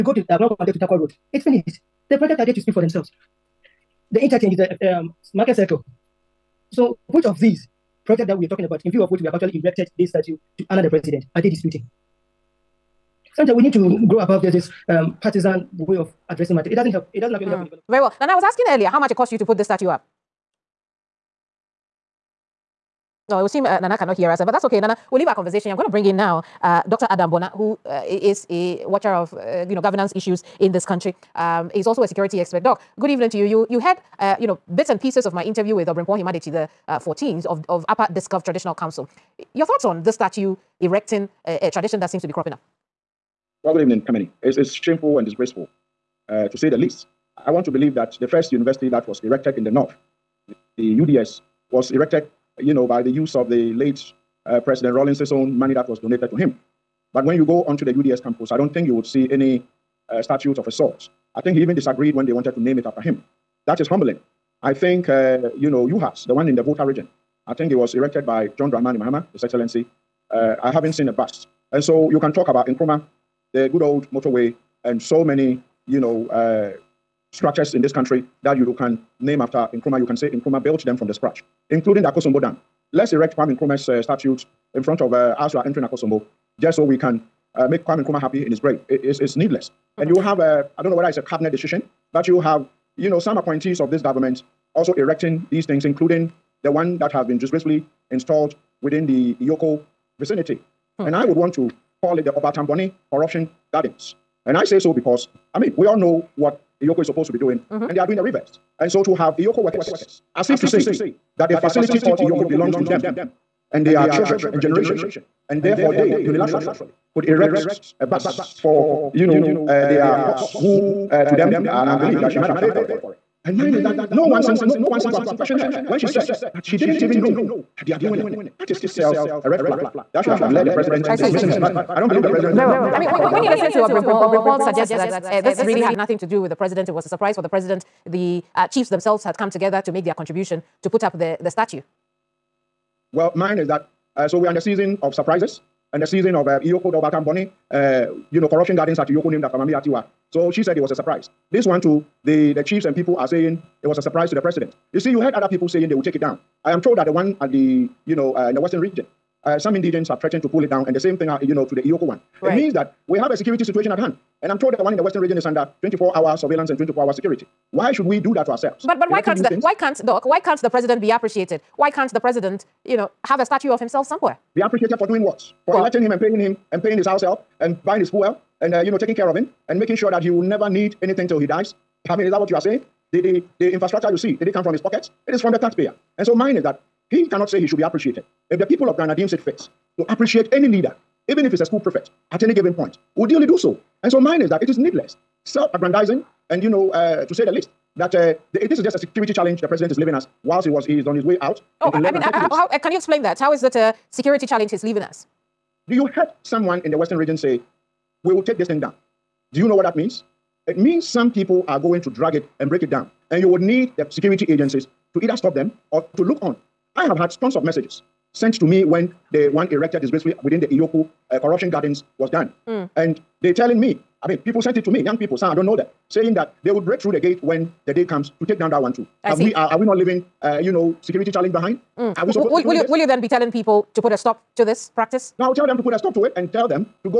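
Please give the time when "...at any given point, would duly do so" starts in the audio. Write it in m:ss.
3:12.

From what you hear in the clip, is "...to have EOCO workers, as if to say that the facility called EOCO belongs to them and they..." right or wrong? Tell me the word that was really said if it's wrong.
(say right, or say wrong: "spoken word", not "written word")
right.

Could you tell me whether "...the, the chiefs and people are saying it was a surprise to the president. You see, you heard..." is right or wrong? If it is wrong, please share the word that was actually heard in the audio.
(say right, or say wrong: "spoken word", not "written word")
right.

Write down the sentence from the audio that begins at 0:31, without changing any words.
Um, he's also a security expert.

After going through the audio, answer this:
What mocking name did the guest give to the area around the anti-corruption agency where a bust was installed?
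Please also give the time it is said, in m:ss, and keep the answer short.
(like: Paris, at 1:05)
Obatamboni Corruption Gardens, at 1:42.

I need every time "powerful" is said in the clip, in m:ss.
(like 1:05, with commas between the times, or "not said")
not said.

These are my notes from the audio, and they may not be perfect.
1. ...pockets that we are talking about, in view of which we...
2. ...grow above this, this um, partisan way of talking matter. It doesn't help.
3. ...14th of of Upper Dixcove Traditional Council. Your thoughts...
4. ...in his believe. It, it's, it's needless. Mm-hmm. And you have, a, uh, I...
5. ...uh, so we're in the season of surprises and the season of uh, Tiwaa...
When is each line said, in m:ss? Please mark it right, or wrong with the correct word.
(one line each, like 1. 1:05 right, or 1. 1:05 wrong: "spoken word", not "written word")
1. 0:08 wrong: "projects", not "pockets"
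2. 0:14 wrong: "addressing", not "talking"
3. 0:36 right
4. 1:28 wrong: "grave", not "believe"
5. 2:24 wrong: "EOCO", not "Tiwaa".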